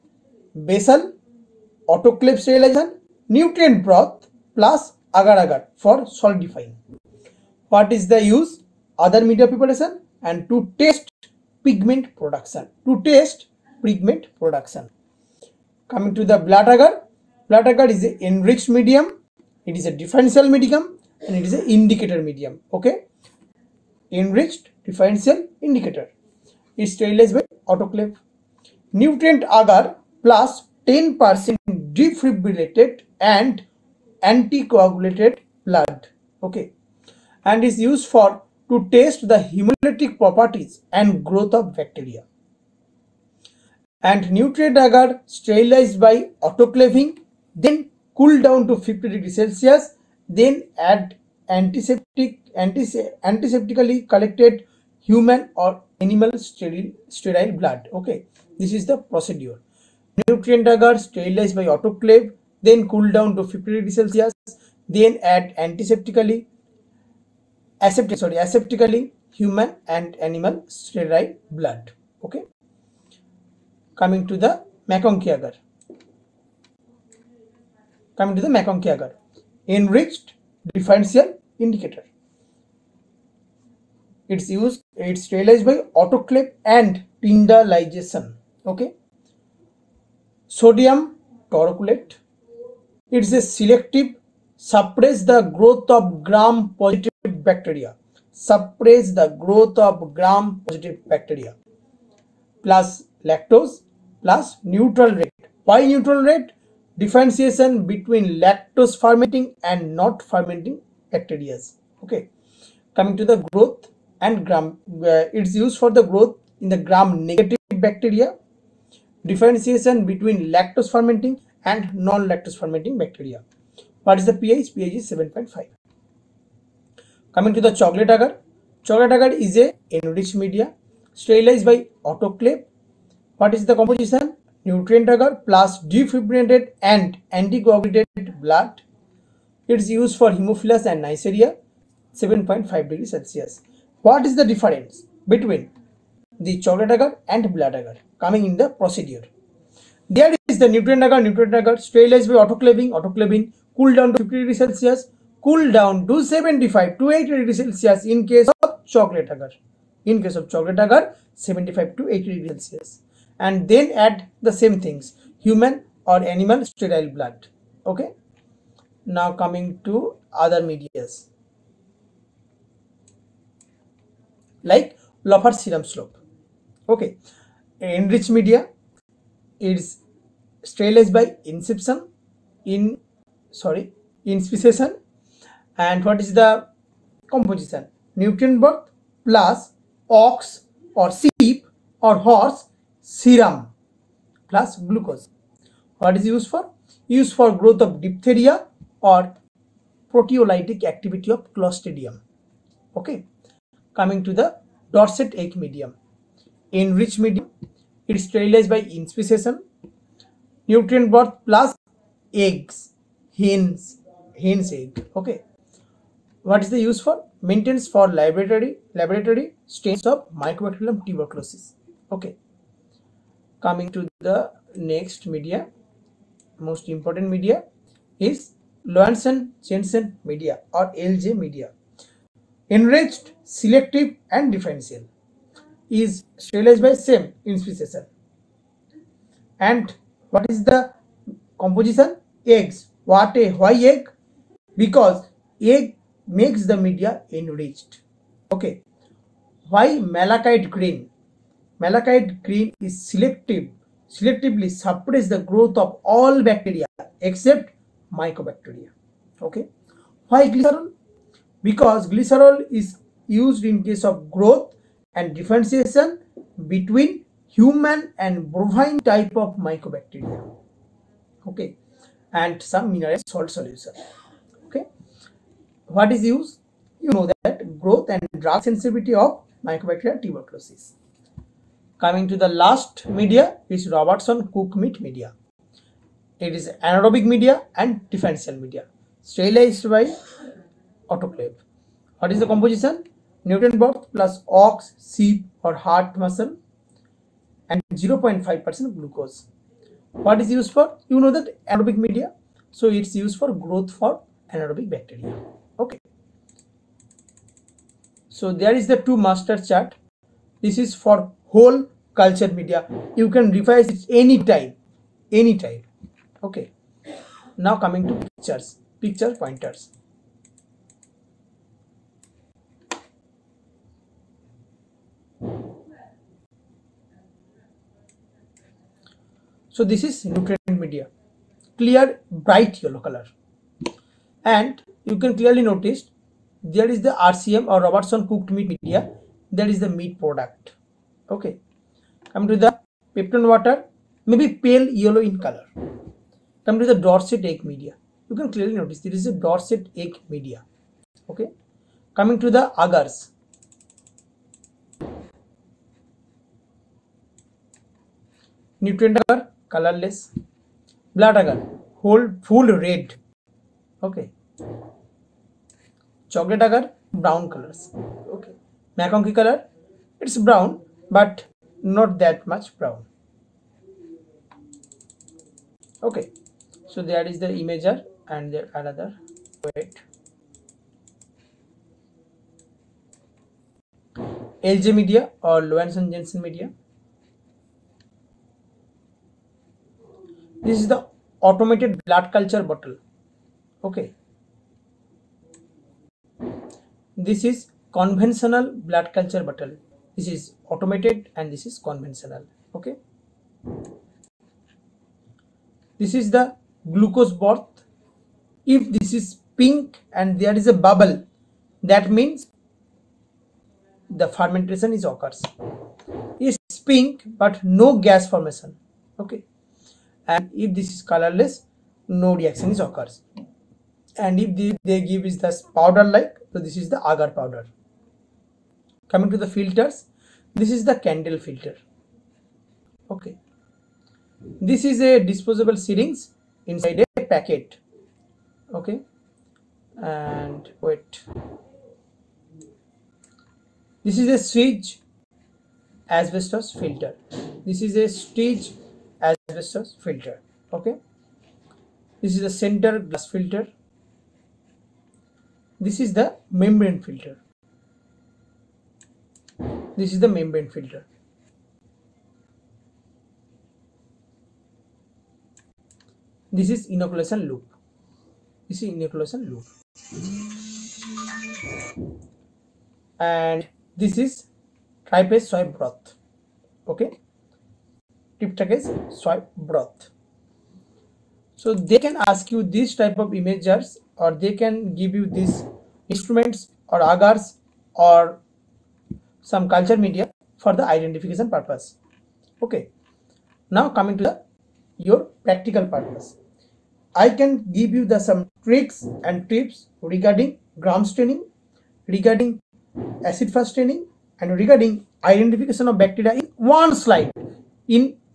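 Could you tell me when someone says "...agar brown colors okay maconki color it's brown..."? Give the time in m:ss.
6:06.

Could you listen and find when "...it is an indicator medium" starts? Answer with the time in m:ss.
0:21.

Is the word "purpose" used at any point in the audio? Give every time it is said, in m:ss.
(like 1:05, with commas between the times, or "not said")
8:11, 8:15.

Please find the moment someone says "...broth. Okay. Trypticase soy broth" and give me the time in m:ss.
7:55.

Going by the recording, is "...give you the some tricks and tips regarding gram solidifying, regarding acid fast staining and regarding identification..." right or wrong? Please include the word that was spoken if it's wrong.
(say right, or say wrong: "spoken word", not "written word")
wrong: "staining", not "solidifying".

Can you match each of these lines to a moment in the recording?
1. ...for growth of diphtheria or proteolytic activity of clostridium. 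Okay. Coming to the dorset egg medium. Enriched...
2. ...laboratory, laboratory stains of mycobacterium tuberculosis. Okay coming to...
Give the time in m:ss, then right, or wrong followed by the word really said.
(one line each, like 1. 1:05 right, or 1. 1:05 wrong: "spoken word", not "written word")
1. 3:17 right
2. 3:38 right.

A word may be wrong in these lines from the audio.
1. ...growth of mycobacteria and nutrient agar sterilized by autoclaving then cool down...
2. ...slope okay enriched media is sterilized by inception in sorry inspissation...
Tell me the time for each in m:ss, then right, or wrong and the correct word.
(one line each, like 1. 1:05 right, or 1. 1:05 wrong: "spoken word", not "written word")
1. 0:41 wrong: "bacteria", not "mycobacteria"
2. 2:55 right.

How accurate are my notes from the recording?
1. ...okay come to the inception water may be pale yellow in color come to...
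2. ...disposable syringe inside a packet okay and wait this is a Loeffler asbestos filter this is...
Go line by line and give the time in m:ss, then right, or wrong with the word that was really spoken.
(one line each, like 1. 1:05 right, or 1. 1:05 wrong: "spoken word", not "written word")
1. 5:41 wrong: "pepton", not "inception"
2. 7:15 wrong: "Seitz", not "Loeffler".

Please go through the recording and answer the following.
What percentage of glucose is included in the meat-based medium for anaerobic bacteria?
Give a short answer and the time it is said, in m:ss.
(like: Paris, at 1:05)
0.5%, at 4:57.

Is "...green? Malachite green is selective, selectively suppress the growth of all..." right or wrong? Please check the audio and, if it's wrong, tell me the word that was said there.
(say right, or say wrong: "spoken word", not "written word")
right.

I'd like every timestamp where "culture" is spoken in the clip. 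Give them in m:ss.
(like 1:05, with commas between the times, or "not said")
5:12, 6:32, 6:39, 8:09.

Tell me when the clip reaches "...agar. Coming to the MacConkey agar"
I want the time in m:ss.
1:15.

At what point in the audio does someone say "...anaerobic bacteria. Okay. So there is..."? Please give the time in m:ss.
5:04.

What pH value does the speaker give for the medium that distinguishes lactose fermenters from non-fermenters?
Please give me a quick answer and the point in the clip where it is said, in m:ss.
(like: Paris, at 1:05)
7.5, at 2:04.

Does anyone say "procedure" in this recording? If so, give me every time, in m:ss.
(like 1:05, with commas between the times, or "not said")
0:58, 2:28.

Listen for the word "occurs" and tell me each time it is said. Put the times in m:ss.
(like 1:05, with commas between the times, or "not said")
6:55, 7:02.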